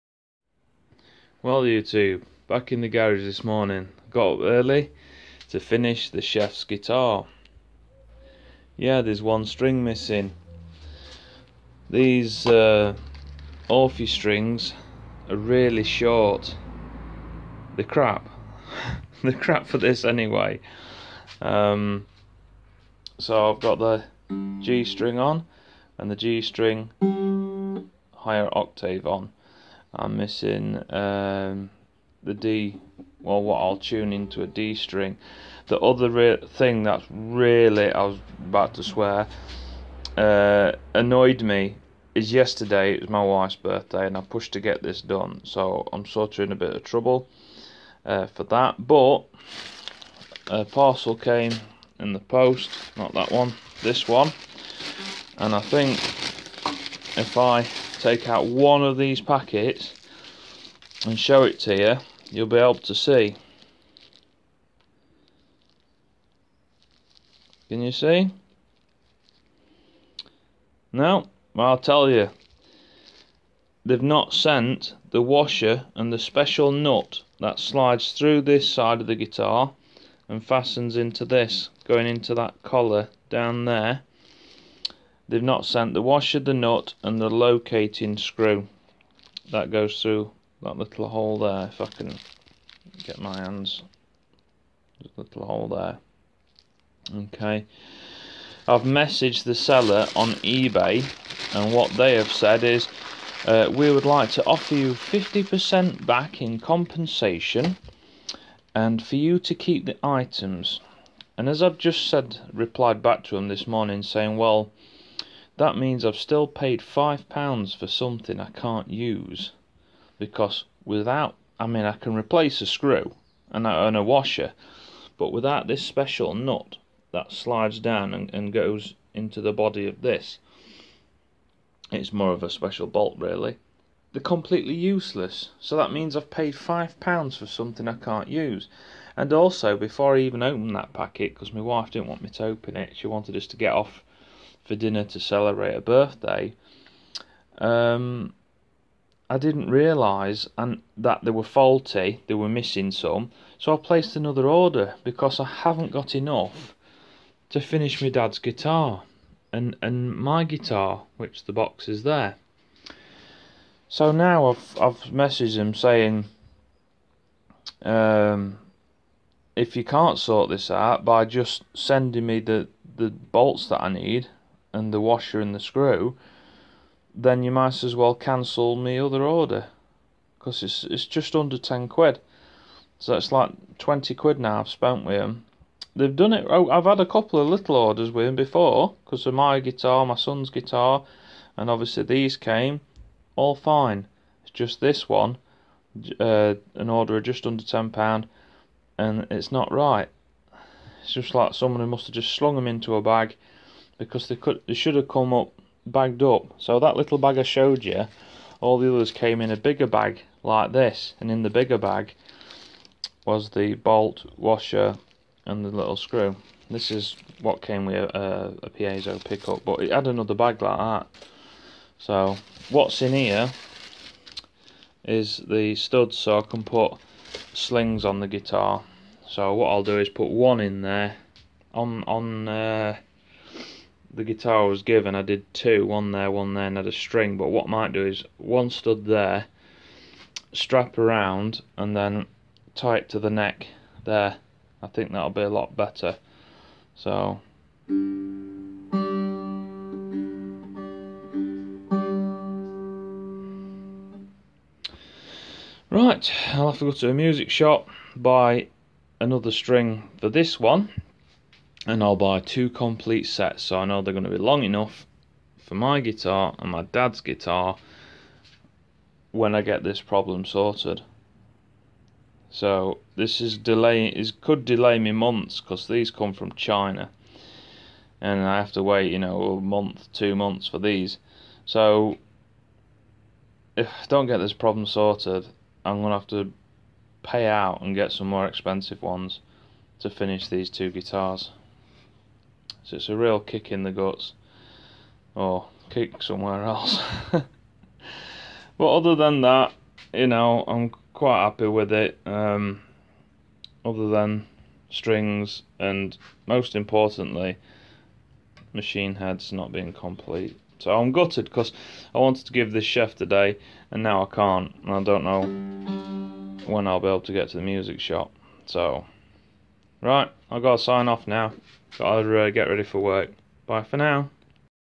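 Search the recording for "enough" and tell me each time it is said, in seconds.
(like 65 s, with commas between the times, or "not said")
156 s, 264 s.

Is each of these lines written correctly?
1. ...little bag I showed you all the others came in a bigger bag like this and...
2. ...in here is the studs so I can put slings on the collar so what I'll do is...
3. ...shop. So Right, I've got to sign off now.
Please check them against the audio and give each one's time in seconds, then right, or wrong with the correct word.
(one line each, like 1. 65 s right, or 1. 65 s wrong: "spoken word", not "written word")
1. 206 s right
2. 223 s wrong: "guitar", not "collar"
3. 317 s right.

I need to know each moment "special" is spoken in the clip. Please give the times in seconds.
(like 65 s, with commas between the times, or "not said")
76 s, 125 s, 132 s.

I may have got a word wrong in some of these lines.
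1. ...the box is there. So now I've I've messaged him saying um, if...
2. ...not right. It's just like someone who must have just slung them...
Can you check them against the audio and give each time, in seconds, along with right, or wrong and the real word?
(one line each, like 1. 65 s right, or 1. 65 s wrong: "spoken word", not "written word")
1. 161 s right
2. 199 s right.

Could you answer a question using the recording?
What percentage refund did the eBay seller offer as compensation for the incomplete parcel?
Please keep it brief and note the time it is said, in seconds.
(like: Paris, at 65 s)
50%, at 104 s.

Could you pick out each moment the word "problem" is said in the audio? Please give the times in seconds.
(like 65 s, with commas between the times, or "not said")
269 s, 284 s.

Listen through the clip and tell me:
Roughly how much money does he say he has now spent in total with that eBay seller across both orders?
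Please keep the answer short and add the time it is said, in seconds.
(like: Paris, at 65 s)
£20, at 183 s.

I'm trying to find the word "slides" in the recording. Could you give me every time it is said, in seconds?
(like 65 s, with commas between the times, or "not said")
77 s, 127 s.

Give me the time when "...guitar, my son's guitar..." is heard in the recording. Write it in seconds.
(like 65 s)
189 s.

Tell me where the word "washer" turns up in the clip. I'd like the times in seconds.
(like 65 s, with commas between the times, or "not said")
75 s, 86 s, 124 s, 175 s, 214 s.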